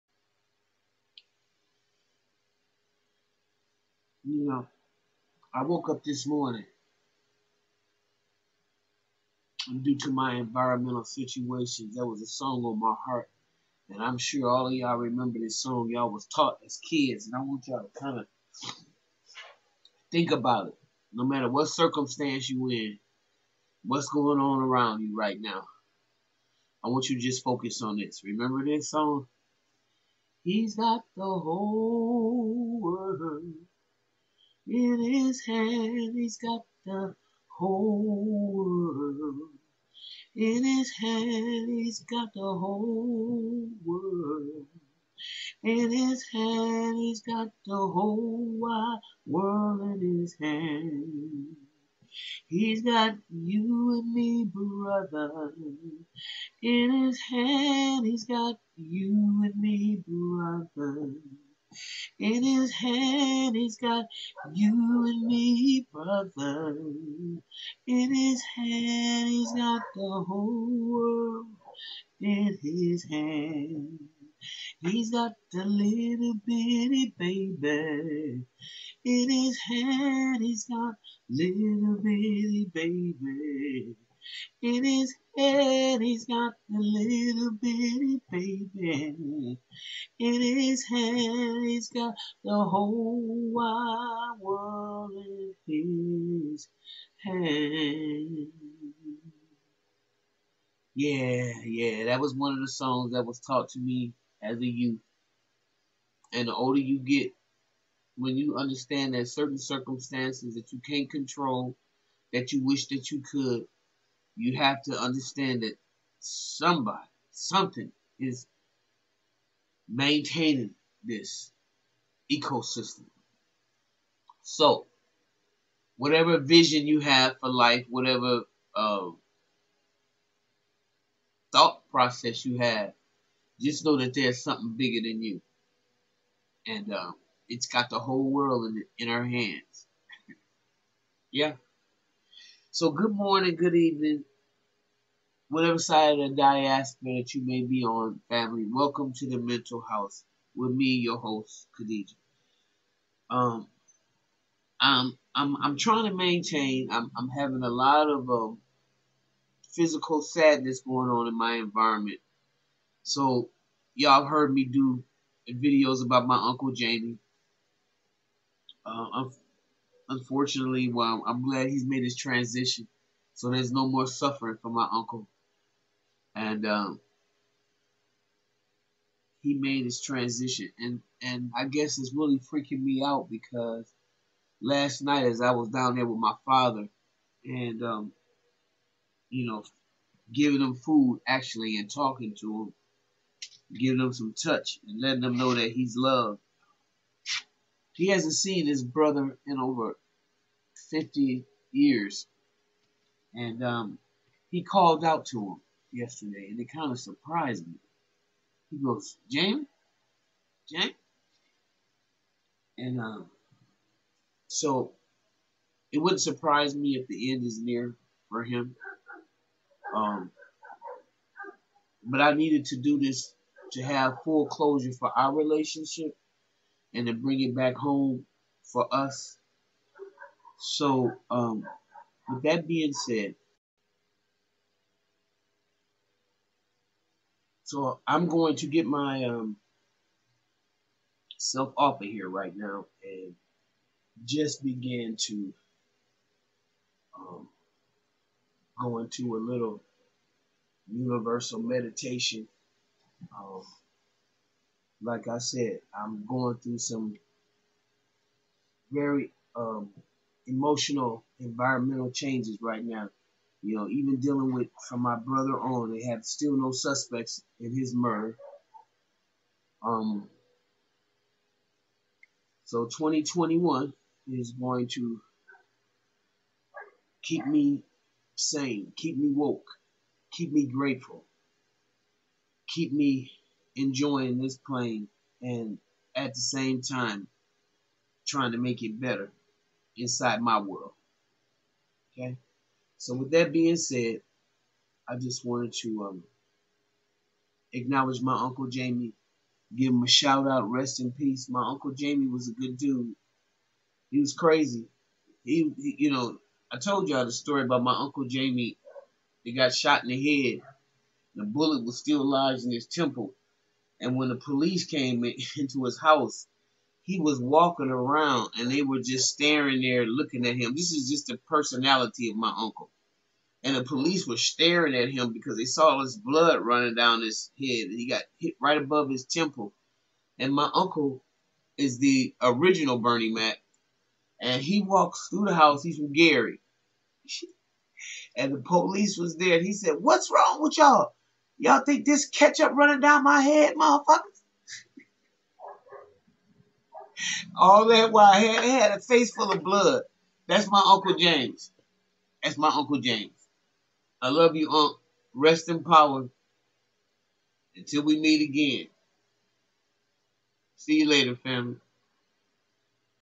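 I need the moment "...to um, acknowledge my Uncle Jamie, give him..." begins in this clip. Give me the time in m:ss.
4:55.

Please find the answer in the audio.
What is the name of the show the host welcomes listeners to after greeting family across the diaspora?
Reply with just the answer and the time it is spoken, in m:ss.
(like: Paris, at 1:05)
The Mental House, at 2:29.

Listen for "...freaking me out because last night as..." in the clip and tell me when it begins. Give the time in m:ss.
3:02.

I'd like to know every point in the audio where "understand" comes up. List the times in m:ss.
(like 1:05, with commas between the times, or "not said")
1:48, 1:54.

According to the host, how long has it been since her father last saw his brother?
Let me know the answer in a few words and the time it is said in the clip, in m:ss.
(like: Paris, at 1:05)
Over 50 years, at 3:19.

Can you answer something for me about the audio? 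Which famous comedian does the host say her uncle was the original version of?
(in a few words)
Bernie Mac.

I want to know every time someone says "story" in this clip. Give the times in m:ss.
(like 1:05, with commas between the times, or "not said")
5:07.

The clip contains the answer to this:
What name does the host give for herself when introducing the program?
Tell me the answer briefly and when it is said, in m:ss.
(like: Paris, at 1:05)
Khadijah, at 2:31.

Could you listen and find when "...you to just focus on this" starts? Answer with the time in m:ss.
0:27.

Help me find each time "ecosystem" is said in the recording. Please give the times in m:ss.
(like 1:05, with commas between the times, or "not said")
2:02.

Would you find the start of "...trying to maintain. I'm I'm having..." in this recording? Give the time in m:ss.
2:35.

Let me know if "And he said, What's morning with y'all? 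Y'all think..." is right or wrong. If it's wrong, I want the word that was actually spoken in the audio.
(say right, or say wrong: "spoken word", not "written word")
wrong: "wrong", not "morning".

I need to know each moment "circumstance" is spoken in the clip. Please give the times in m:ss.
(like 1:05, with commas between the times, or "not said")
0:21, 1:49.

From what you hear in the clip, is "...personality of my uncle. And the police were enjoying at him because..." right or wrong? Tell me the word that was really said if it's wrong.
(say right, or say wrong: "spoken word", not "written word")
wrong: "staring", not "enjoying".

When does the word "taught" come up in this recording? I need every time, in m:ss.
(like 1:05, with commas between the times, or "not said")
0:16, 1:43.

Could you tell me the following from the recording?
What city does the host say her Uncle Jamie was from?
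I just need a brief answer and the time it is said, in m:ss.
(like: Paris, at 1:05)
Gary, at 5:36.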